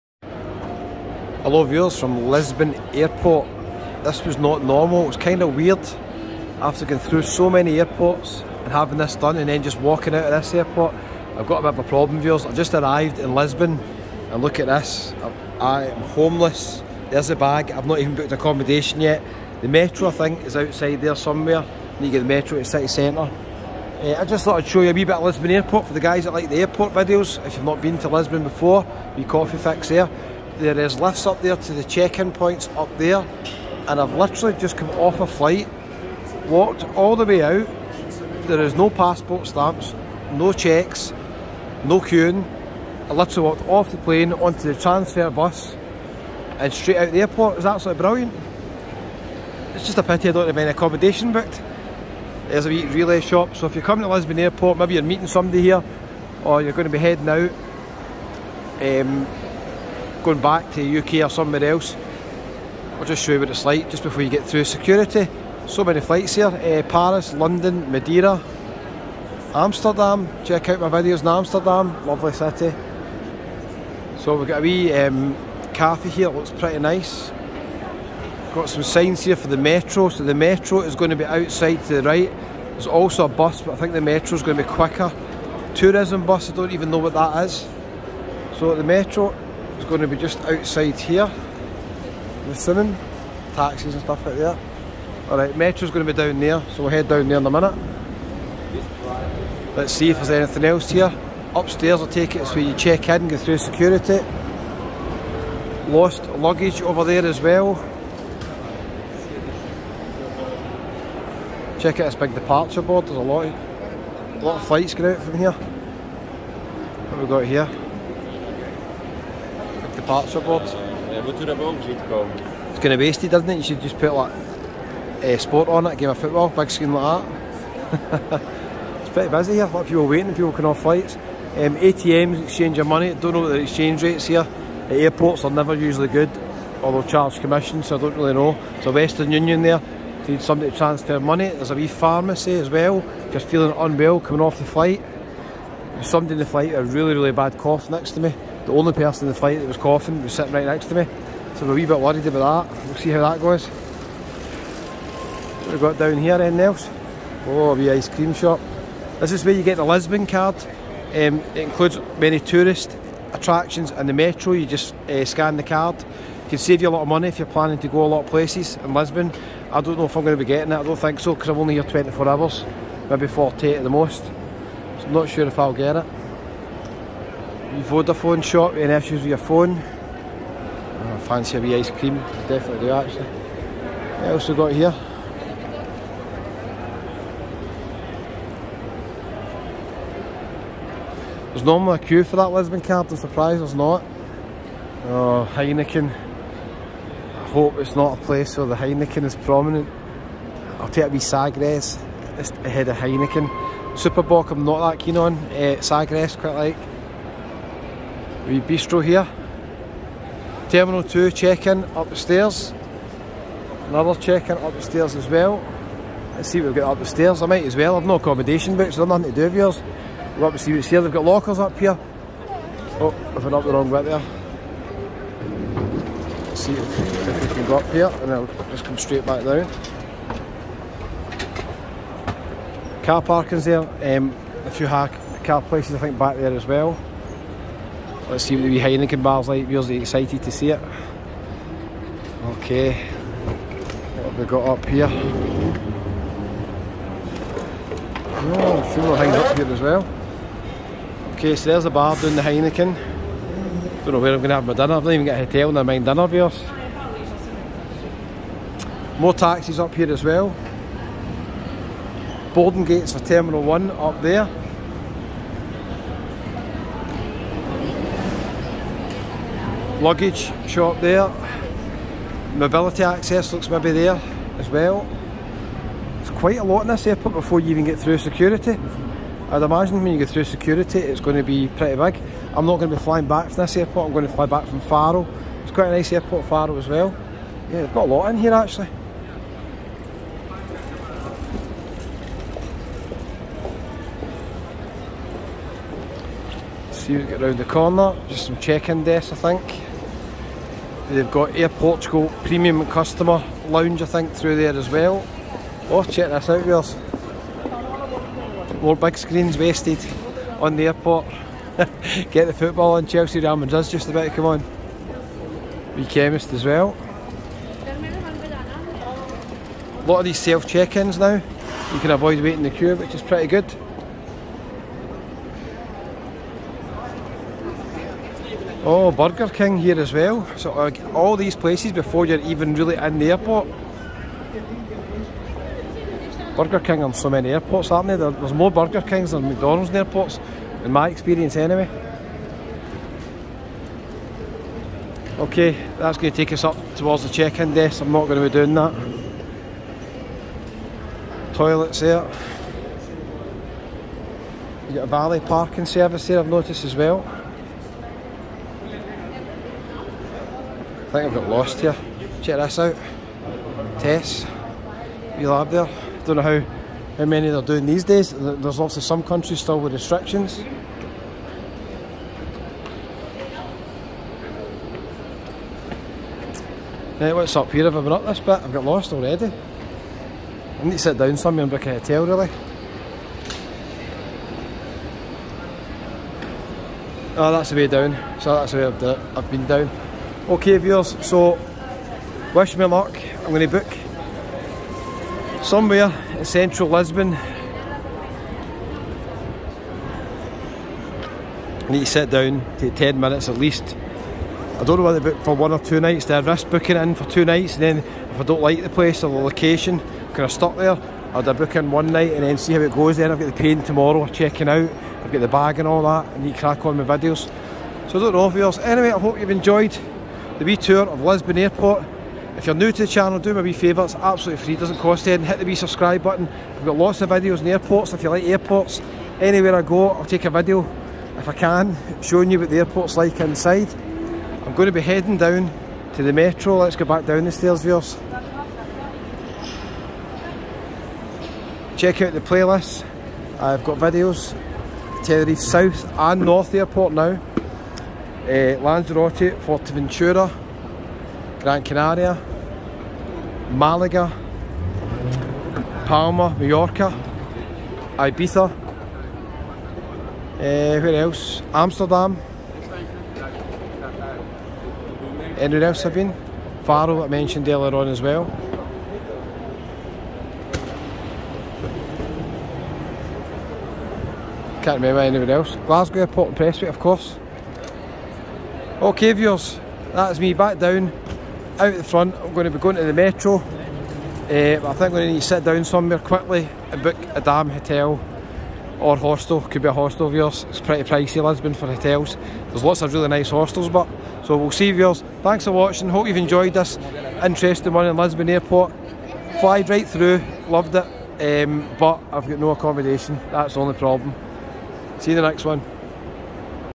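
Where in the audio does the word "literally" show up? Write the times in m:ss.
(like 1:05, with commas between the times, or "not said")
0:34, 0:43.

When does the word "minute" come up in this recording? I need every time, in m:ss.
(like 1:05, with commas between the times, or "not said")
1:37, 6:43.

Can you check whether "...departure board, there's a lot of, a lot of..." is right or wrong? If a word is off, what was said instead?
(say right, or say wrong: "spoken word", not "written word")
right.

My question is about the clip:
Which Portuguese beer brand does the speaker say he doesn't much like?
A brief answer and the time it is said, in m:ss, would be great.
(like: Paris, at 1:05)
Super Bock, at 3:23.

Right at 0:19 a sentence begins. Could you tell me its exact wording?
The metro I think is outside there somewhere.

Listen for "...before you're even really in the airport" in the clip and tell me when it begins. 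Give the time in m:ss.
5:31.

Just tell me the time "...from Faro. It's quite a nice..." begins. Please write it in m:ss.
4:44.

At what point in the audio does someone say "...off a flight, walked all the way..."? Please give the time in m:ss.
0:34.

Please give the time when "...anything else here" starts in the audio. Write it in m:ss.
1:40.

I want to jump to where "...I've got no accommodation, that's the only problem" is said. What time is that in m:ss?
8:22.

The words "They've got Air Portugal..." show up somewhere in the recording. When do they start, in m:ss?
5:01.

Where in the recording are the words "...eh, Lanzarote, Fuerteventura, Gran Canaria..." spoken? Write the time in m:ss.
7:28.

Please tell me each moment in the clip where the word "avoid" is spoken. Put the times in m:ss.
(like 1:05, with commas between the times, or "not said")
5:22.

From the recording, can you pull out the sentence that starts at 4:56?
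see we has get round the corner.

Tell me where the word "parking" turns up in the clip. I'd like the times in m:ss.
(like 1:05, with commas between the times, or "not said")
3:53, 5:55.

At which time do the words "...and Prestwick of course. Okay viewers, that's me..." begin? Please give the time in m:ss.
7:56.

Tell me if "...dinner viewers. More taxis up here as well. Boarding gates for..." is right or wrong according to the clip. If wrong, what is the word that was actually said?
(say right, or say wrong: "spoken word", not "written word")
right.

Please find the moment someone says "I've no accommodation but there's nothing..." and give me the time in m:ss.
3:37.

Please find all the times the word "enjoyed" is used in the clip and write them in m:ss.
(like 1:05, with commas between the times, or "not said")
6:59, 8:16.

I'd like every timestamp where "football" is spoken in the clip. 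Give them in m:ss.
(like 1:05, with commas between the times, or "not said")
2:06, 5:12.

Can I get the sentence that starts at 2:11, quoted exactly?
Um, ATMs, exchange of money, don't know what the exchange rates here.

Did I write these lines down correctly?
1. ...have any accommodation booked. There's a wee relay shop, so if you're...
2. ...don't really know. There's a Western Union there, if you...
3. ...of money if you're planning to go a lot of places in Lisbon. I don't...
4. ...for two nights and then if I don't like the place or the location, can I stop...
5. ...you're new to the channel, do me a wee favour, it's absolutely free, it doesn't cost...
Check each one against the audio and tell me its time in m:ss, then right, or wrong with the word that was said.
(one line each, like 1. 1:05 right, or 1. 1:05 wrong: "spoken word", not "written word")
1. 0:50 right
2. 2:18 right
3. 2:47 right
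4. 6:47 right
5. 7:02 right.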